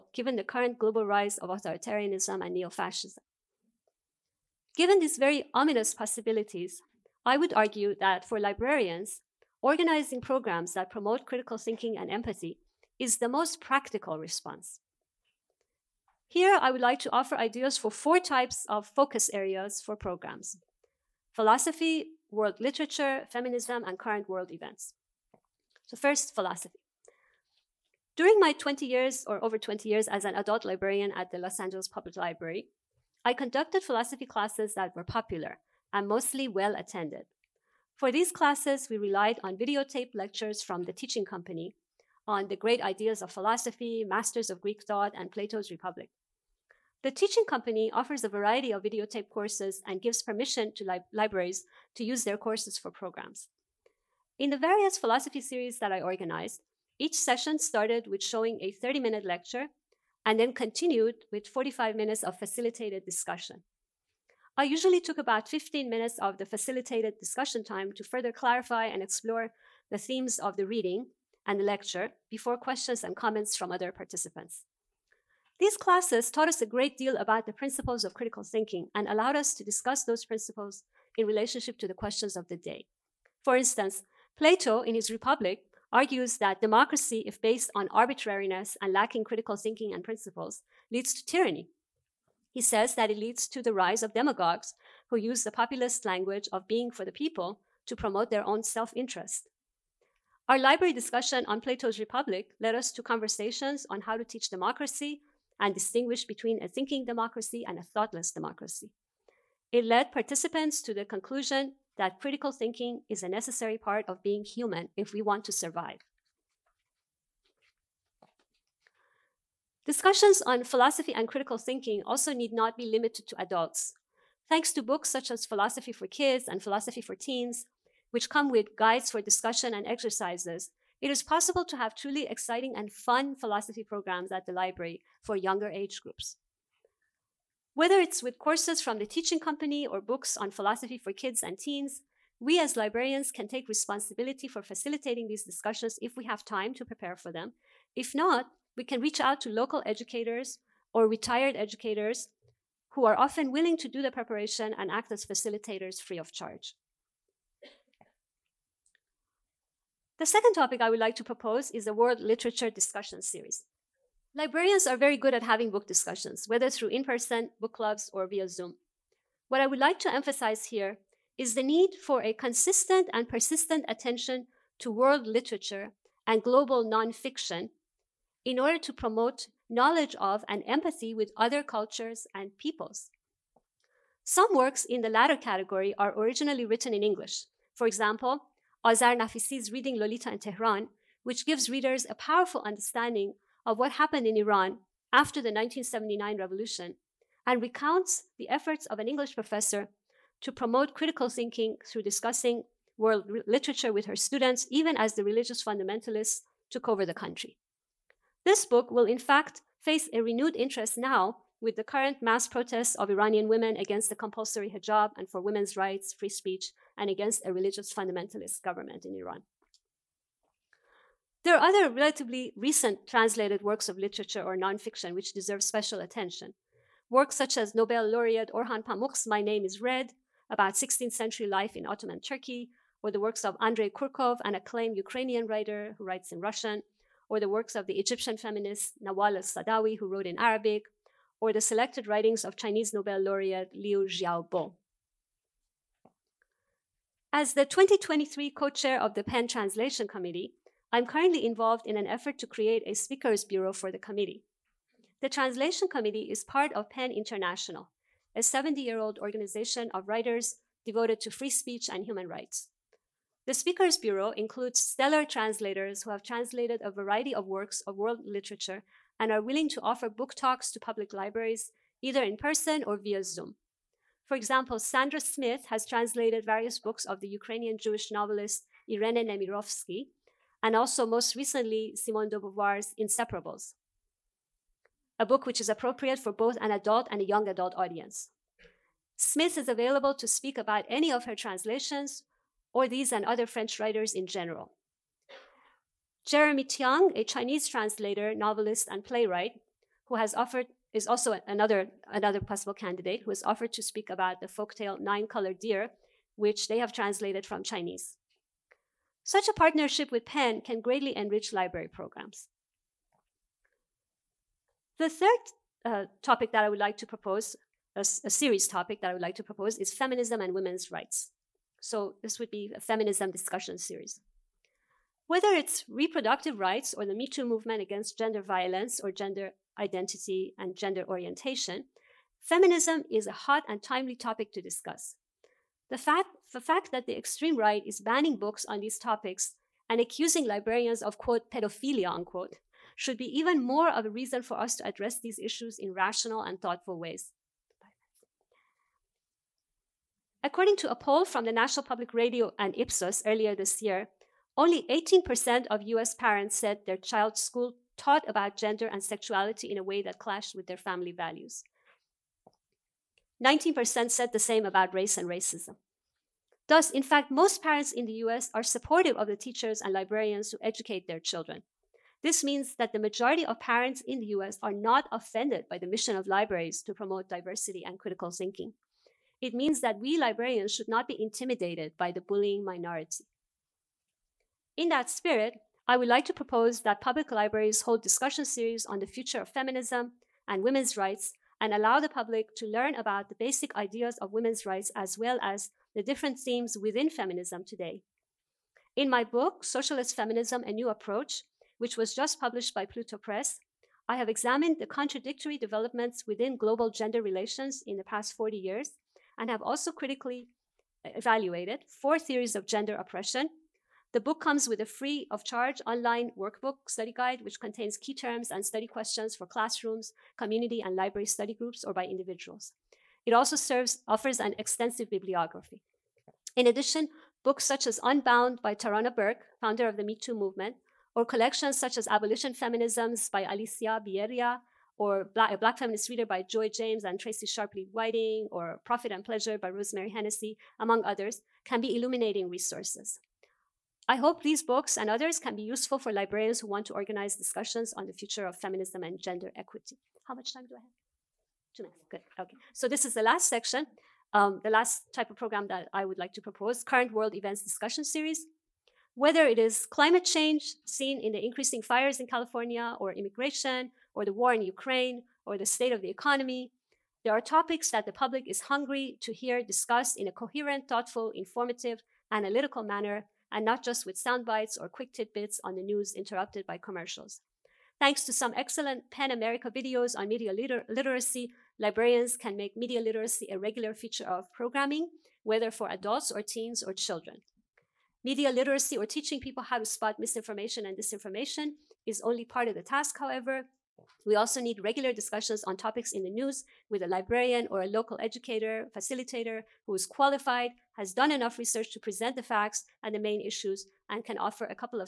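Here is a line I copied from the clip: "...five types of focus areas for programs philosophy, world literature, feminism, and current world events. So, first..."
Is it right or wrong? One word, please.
wrong.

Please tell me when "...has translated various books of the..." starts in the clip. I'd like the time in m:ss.
4:35.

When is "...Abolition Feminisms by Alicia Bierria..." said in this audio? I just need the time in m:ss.
7:12.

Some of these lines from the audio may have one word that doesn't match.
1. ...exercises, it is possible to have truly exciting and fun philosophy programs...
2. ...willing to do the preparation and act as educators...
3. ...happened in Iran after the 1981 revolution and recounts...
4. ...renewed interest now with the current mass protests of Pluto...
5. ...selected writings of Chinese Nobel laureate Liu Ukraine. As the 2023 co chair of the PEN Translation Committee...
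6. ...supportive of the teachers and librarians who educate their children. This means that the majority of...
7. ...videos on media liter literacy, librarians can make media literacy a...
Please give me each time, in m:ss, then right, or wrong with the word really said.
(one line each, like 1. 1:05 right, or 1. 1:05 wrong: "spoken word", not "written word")
1. 2:09 right
2. 2:33 wrong: "facilitators", not "educators"
3. 3:13 wrong: "1979", not "1981"
4. 3:30 wrong: "Iranian", not "Pluto"
5. 4:01 wrong: "Xiaobo", not "Ukraine"
6. 6:08 right
7. 7:59 right.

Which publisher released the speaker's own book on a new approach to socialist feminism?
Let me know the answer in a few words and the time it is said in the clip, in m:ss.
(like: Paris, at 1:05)
Pluto Press, at 6:42.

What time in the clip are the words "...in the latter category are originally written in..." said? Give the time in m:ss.
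3:04.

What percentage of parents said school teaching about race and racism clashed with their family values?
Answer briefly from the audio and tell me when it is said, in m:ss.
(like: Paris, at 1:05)
19%, at 6:03.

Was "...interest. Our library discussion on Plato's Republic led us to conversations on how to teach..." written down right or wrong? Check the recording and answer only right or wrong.
right.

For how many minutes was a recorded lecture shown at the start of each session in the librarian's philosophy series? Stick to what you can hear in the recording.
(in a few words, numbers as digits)
30.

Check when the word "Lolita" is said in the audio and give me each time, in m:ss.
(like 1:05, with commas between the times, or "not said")
3:09.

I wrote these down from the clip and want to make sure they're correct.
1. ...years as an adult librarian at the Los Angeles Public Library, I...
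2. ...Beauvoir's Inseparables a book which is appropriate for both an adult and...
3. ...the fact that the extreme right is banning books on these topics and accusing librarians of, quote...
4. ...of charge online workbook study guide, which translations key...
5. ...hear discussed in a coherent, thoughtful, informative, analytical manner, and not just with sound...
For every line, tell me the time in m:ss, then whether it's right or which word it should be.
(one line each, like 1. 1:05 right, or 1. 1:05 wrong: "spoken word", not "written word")
1. 0:29 right
2. 4:42 right
3. 5:36 right
4. 6:55 wrong: "contains", not "translations"
5. 7:49 right.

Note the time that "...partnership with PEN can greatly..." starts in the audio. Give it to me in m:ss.
5:09.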